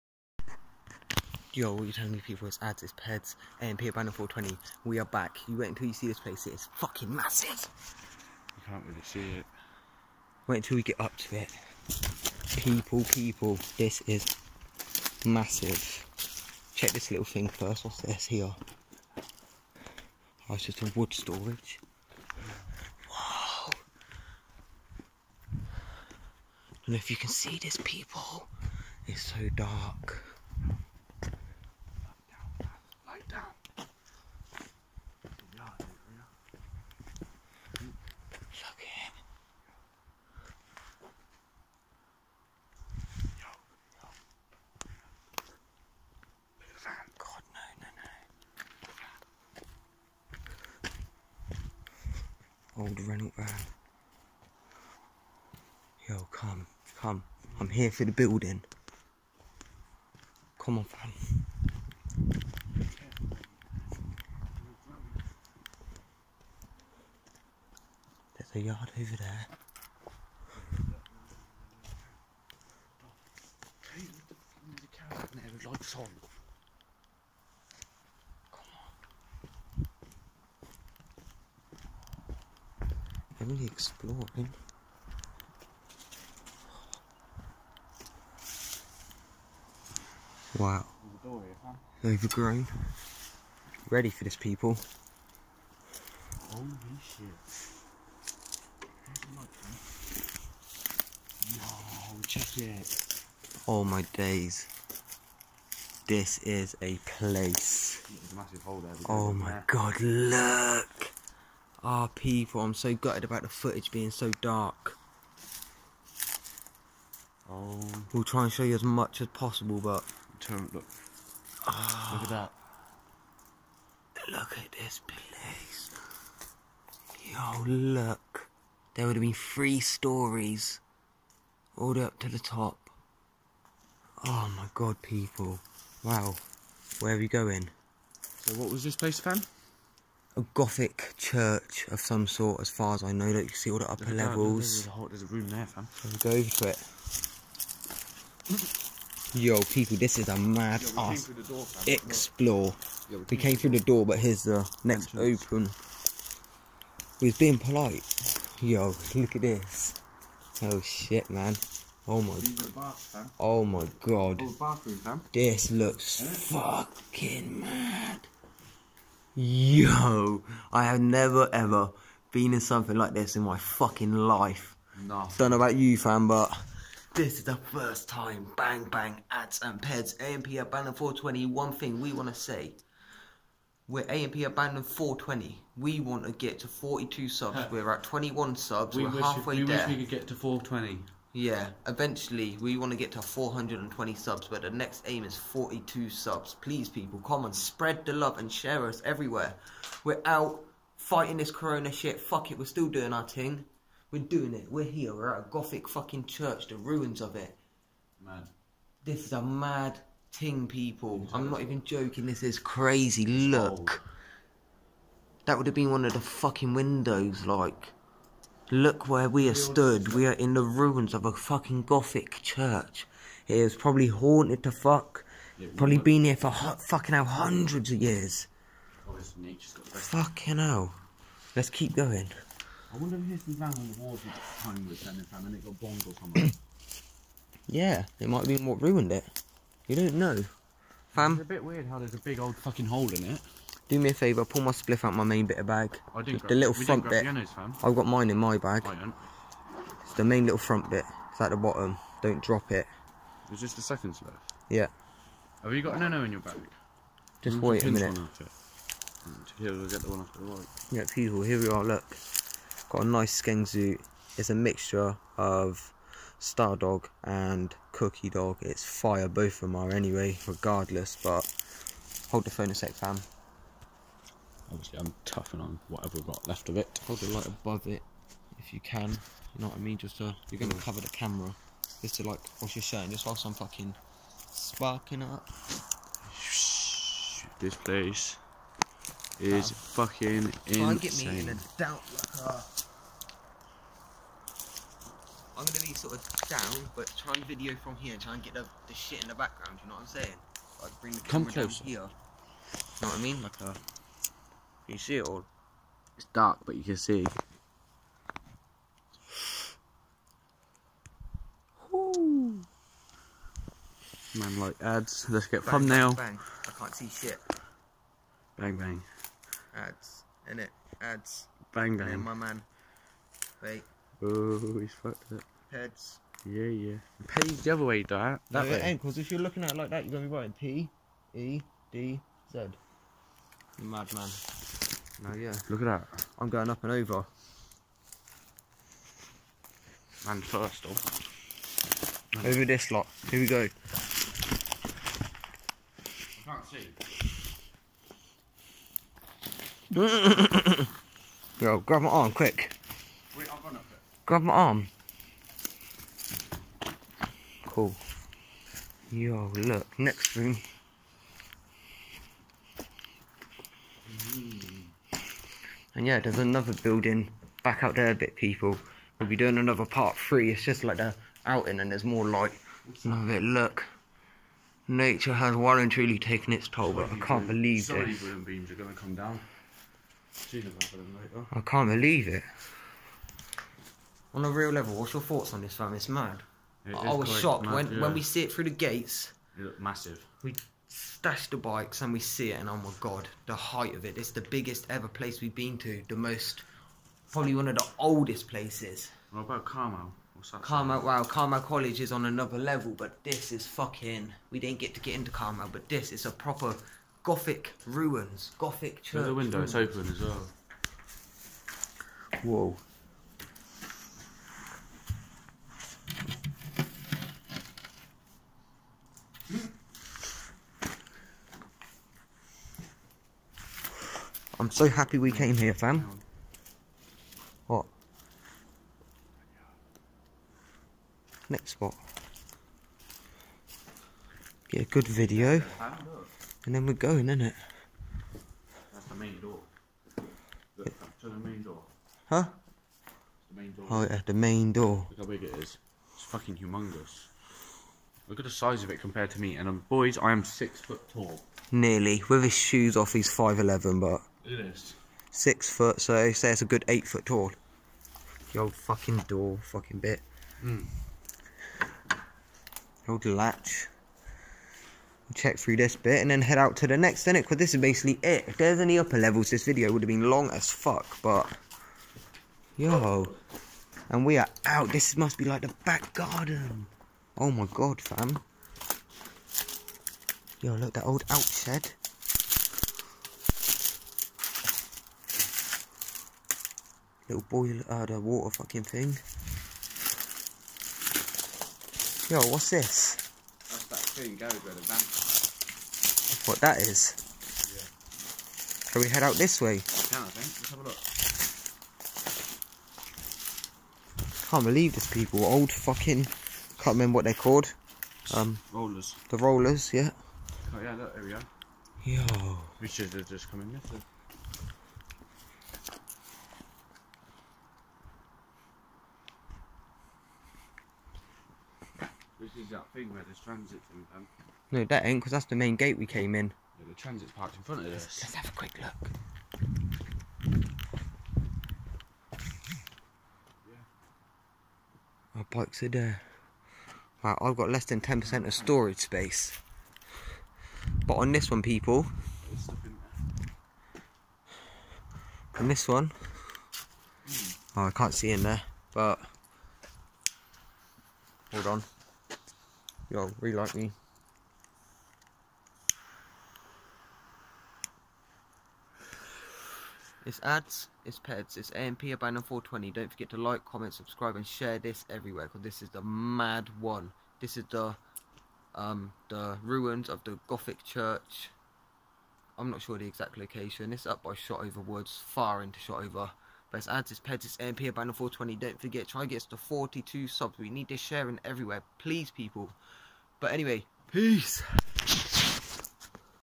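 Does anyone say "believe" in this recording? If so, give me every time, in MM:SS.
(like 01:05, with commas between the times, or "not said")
06:17, 06:21, 08:24.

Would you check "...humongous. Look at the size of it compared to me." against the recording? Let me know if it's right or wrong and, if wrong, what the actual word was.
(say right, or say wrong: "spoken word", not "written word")
right.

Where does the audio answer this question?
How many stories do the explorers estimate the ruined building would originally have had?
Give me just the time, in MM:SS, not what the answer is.
02:09.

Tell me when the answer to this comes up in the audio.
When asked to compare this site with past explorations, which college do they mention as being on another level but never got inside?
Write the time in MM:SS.
06:41.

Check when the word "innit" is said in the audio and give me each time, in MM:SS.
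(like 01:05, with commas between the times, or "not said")
07:17, 07:47.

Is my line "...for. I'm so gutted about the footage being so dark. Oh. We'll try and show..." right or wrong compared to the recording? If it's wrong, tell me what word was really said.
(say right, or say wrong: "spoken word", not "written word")
right.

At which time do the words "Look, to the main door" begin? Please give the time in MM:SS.
07:20.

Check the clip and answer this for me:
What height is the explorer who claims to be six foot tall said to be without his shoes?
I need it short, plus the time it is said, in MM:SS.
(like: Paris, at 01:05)
5'11", at 07:33.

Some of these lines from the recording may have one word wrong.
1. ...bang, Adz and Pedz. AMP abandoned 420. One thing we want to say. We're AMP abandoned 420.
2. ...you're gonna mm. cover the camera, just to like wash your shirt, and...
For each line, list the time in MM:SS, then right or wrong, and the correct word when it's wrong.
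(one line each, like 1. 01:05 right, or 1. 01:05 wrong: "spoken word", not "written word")
1. 02:58 right
2. 04:40 right.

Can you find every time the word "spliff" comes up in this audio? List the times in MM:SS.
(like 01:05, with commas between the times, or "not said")
04:04, 04:14.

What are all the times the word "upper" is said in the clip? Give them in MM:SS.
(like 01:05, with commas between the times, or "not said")
02:23, 07:48.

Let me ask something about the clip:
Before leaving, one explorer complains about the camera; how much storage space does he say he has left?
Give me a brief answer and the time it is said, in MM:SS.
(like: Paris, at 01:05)
Less than 10%, at 08:57.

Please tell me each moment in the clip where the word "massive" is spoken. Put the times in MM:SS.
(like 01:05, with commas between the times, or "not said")
00:07, 00:15, 06:29.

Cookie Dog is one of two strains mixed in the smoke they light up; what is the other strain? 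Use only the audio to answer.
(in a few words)
Star Dog.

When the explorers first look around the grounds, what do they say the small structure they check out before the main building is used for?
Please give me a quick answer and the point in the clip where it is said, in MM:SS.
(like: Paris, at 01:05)
Wood storage, at 00:20.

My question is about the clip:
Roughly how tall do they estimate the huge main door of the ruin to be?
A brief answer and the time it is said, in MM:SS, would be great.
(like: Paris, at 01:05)
8 foot, at 07:36.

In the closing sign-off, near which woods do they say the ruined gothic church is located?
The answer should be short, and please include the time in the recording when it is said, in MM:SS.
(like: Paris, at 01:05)
Shotover Woods, at 09:34.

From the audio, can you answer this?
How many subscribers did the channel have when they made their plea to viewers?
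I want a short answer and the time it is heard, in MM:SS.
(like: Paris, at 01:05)
21, at 03:08.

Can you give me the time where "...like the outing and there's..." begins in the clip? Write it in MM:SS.
06:10.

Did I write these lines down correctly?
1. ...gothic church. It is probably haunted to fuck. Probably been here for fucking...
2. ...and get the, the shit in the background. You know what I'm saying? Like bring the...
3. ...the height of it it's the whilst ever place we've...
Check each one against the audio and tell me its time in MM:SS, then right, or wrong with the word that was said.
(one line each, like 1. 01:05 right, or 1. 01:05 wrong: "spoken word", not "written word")
1. 03:41 right
2. 04:58 right
3. 06:33 wrong: "biggest", not "whilst".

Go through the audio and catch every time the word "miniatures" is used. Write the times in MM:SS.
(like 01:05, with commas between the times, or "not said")
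not said.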